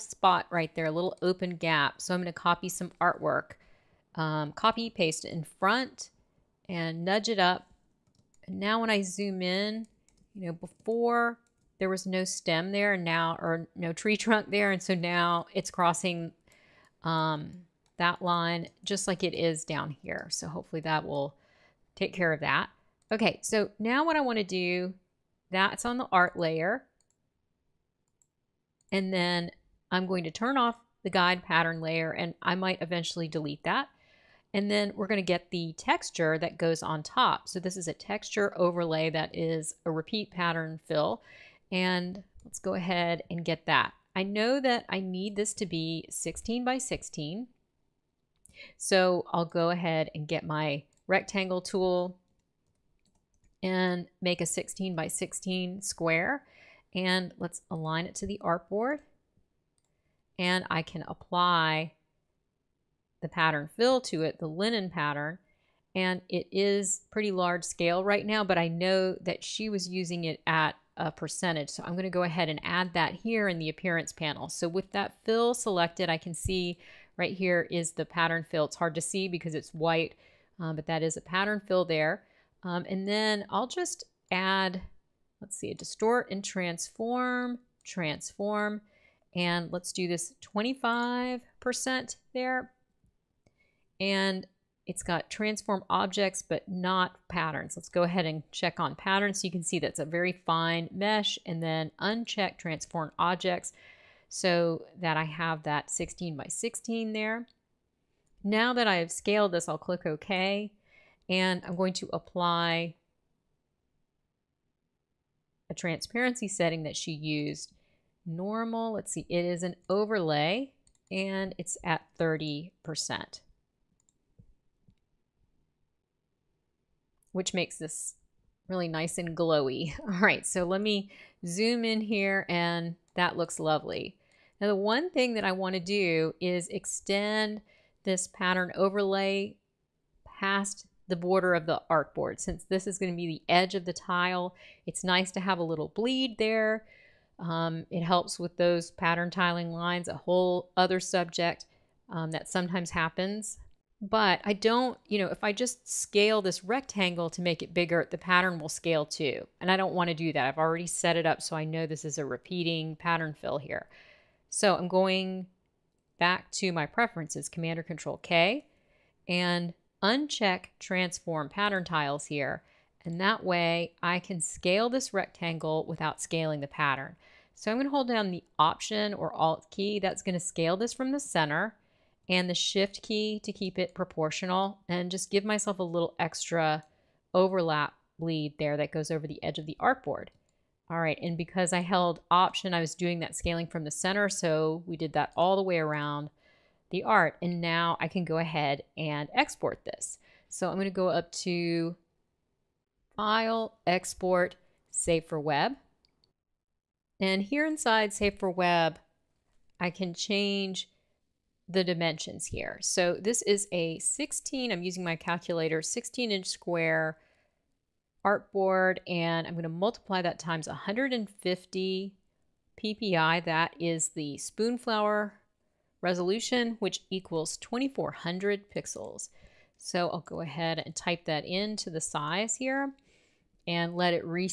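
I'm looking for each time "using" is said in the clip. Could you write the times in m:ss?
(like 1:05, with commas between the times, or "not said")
1:09, 3:34.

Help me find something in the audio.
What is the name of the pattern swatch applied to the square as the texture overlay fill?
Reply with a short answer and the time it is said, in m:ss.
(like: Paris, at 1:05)
linen, at 1:04.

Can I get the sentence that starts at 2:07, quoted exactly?
which makes this really nice and glowy.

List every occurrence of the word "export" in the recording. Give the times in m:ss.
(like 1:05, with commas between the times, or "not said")
3:19, 3:23.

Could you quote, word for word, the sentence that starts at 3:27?
And here inside Save for Web, I can change the dimensions here.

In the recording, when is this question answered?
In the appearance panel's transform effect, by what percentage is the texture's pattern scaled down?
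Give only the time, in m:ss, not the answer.
1:30.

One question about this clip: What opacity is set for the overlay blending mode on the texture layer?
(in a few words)
30%.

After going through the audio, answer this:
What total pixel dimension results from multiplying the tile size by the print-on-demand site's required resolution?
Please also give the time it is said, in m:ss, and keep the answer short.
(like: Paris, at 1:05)
2400 pixels, at 3:47.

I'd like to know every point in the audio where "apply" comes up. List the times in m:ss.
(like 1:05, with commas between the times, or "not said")
1:01, 1:52.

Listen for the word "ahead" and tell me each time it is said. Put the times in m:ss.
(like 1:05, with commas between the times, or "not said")
0:42, 0:49, 1:12, 1:38, 3:18, 3:50.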